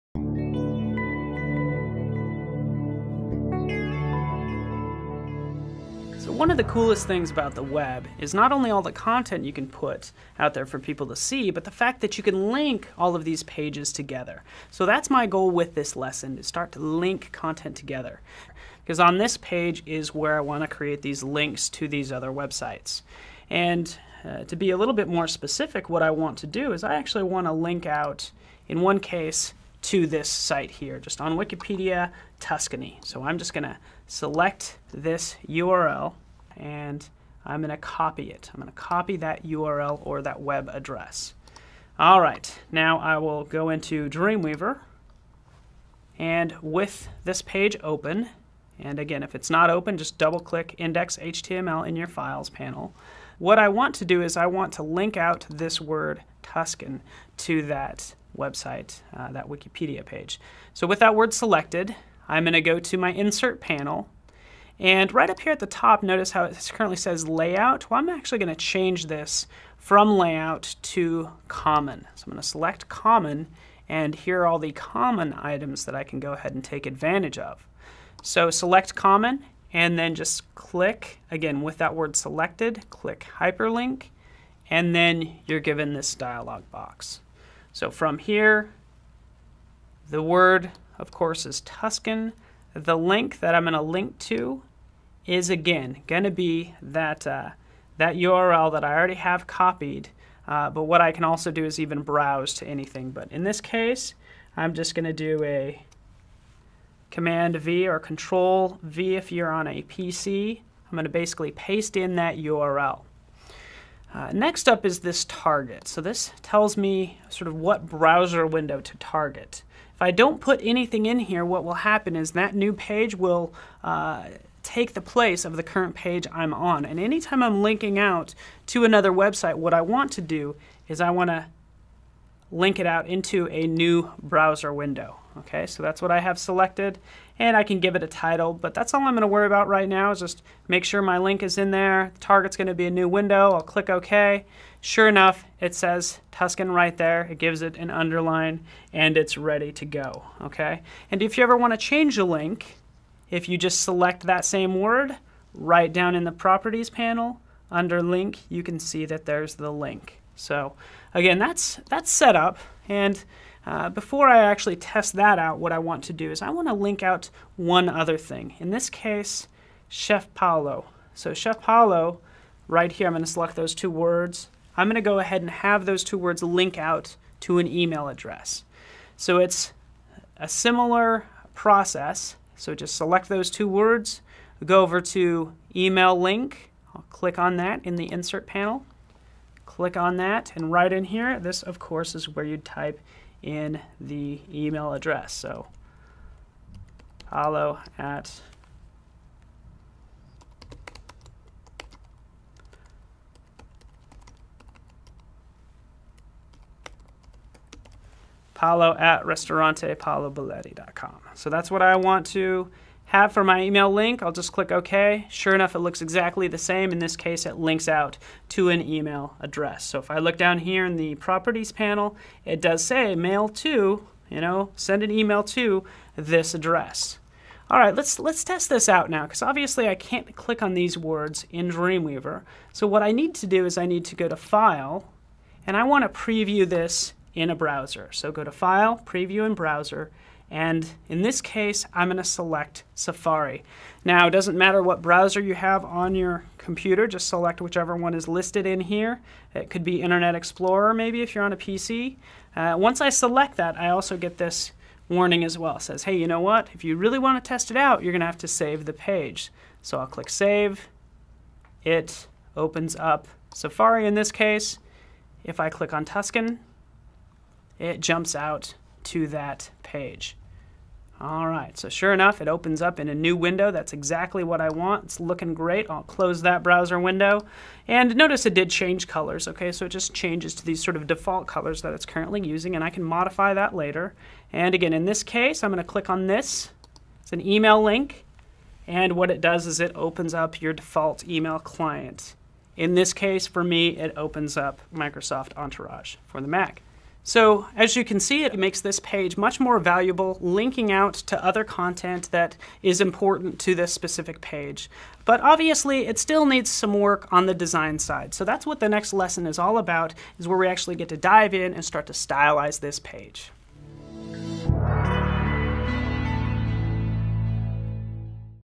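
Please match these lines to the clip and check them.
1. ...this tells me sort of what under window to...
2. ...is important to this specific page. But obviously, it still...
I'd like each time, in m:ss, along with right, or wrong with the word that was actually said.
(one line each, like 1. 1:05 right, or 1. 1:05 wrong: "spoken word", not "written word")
1. 1:56 wrong: "browser", not "under"
2. 5:02 right.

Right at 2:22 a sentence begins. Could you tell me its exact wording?
The target's going to be a new window.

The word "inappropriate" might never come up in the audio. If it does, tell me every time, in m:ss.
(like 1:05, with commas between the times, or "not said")
not said.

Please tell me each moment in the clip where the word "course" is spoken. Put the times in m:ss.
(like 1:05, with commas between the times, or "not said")
1:31, 3:11.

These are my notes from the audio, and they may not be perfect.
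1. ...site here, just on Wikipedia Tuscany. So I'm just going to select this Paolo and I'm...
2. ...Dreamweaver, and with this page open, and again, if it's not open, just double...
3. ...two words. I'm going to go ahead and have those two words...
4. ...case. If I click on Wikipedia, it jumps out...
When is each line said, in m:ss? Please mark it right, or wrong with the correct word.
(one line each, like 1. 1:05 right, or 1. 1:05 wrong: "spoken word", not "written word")
1. 0:30 wrong: "URL", not "Paolo"
2. 0:44 right
3. 2:53 right
4. 4:24 wrong: "Tuscan", not "Wikipedia".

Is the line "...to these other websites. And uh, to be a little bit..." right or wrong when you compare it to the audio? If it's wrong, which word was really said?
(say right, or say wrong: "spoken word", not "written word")
right.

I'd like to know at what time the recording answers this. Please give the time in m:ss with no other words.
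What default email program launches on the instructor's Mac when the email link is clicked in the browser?
4:54.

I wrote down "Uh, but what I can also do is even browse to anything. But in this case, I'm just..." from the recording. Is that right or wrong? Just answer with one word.
right.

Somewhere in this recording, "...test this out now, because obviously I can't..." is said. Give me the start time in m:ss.
3:48.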